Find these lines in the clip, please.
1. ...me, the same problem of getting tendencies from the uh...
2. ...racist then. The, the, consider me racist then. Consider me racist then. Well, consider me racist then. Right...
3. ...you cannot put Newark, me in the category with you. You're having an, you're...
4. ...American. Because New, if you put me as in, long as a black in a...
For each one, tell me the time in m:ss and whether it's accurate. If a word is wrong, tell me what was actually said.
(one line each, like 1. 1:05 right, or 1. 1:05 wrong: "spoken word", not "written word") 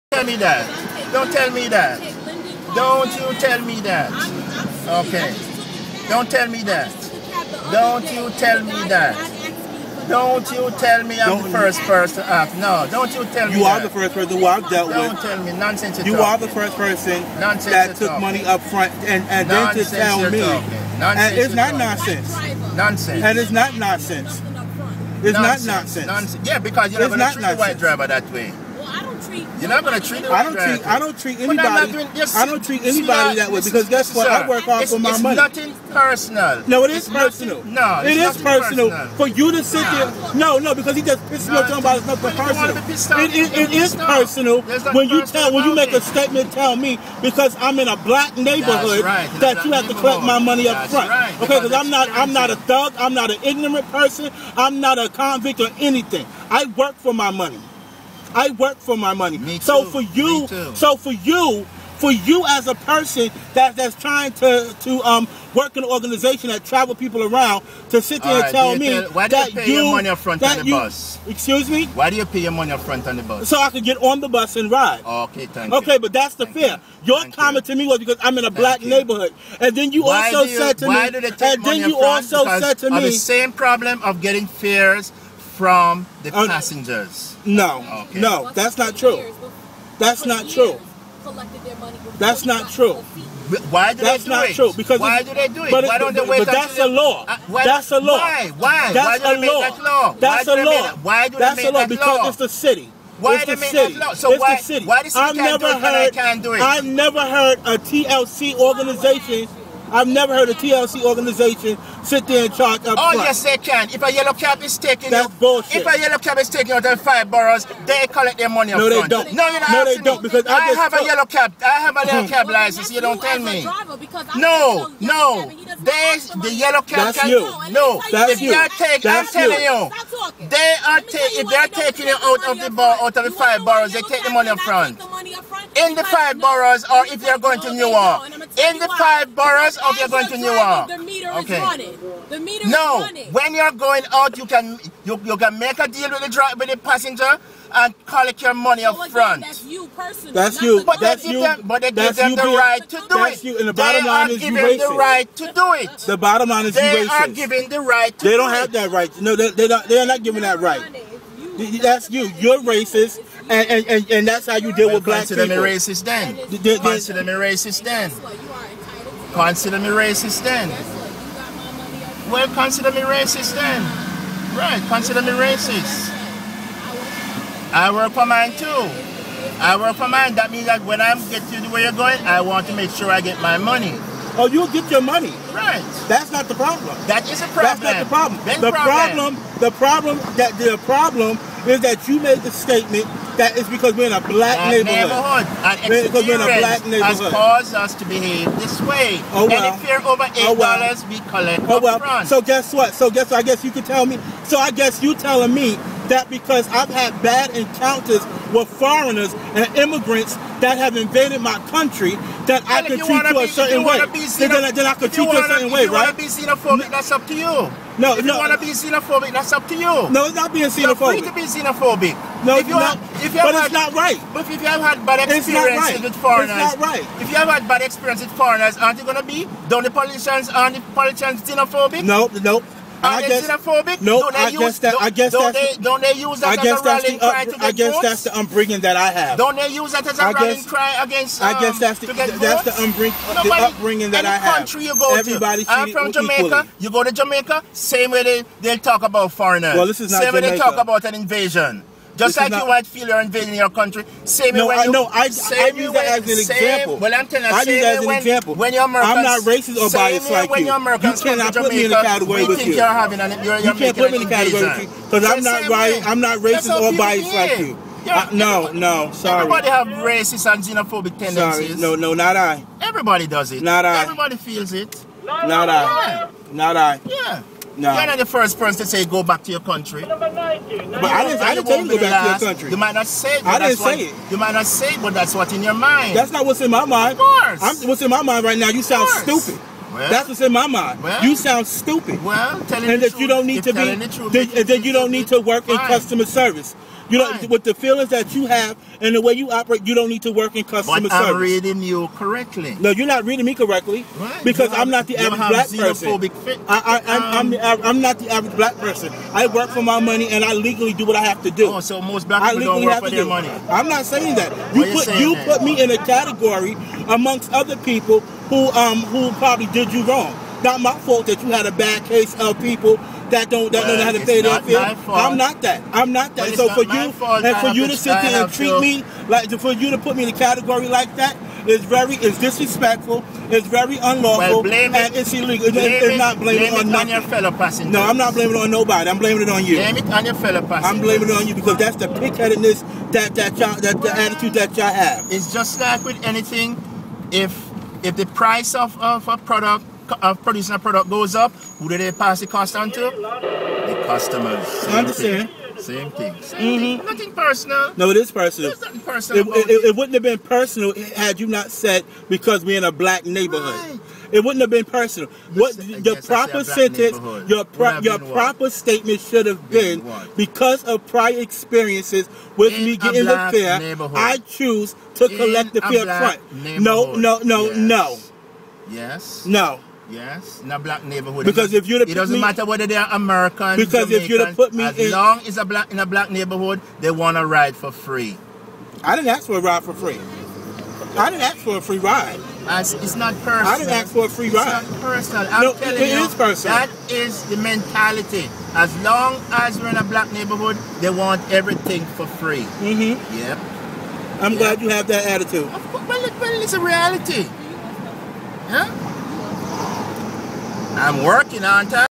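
1. 1:22 wrong: "fares", not "tendencies"
2. 2:45 right
3. 4:21 wrong: "Jamaica", not "Newark"
4. 6:23 wrong: "Jamaican", not "New".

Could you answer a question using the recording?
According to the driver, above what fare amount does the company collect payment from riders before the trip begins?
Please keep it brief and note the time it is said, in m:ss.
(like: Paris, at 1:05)
$8, at 3:20.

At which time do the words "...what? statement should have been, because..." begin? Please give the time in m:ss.
6:08.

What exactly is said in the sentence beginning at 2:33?
You, and the bottom they line are is giving you racist.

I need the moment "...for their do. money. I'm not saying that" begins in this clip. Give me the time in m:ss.
5:13.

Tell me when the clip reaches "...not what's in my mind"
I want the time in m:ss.
4:46.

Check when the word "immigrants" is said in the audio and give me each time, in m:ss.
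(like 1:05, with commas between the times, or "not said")
3:29.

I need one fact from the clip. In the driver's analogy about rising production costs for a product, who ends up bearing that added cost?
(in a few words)
The customers.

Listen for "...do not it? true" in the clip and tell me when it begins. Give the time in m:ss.
1:34.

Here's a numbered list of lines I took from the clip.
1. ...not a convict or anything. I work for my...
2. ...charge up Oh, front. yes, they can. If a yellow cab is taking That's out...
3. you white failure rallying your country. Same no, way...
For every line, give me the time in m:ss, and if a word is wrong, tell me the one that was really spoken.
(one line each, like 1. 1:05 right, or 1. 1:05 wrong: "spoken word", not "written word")
1. 0:54 right
2. 1:52 right
3. 4:12 wrong: "invading", not "rallying".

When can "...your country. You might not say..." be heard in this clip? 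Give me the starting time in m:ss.
4:42.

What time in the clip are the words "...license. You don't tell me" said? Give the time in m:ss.
2:02.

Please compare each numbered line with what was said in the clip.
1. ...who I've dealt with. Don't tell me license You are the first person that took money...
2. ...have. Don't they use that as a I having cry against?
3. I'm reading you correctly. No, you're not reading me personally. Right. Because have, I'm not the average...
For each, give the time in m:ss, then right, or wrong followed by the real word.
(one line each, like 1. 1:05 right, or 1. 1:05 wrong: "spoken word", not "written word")
1. 0:14 wrong: "nonsense", not "license"
2. 3:59 wrong: "rallying", not "having"
3. 5:01 wrong: "correctly", not "personally".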